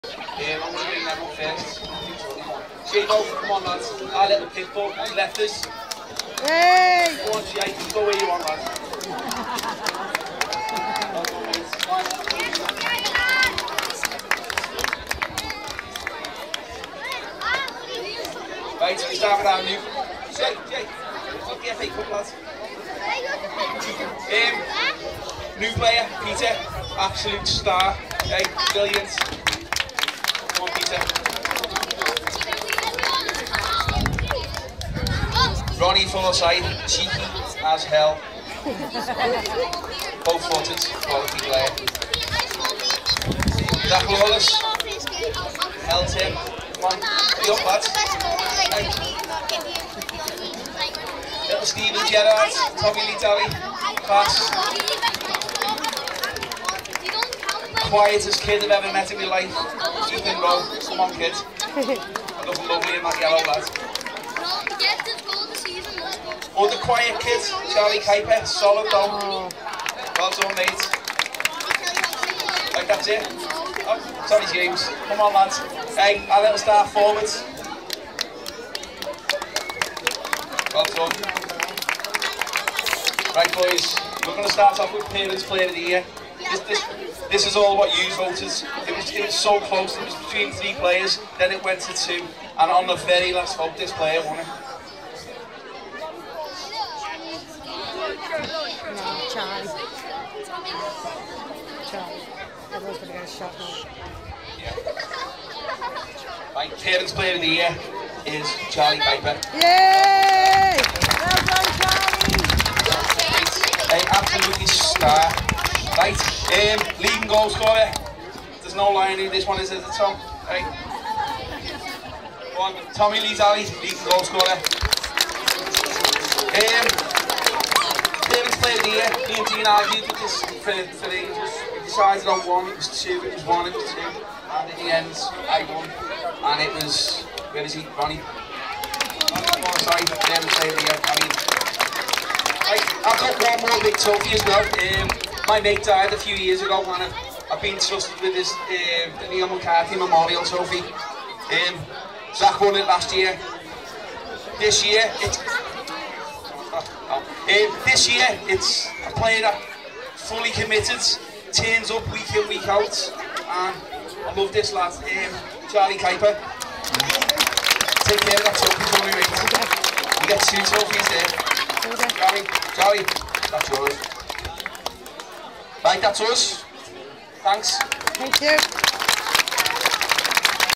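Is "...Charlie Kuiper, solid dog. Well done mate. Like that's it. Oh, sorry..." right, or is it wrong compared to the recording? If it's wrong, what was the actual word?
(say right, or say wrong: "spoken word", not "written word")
right.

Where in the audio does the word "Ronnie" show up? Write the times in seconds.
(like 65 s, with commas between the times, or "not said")
35 s, 137 s.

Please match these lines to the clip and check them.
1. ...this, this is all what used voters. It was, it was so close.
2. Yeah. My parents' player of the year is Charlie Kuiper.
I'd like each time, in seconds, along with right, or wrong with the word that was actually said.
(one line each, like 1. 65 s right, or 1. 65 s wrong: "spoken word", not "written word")
1. 86 s right
2. 104 s right.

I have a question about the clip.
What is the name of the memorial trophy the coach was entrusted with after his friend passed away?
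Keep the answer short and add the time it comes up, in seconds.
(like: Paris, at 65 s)
Neil McCarthy Memorial Trophy, at 149 s.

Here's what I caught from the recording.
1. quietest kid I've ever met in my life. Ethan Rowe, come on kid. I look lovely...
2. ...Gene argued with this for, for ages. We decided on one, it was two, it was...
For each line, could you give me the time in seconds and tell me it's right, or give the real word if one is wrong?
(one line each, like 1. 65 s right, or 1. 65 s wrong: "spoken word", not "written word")
1. 57 s right
2. 129 s right.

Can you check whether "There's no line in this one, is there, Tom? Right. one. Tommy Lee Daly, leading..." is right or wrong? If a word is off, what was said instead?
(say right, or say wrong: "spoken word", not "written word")
right.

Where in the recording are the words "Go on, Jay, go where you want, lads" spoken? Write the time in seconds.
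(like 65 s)
7 s.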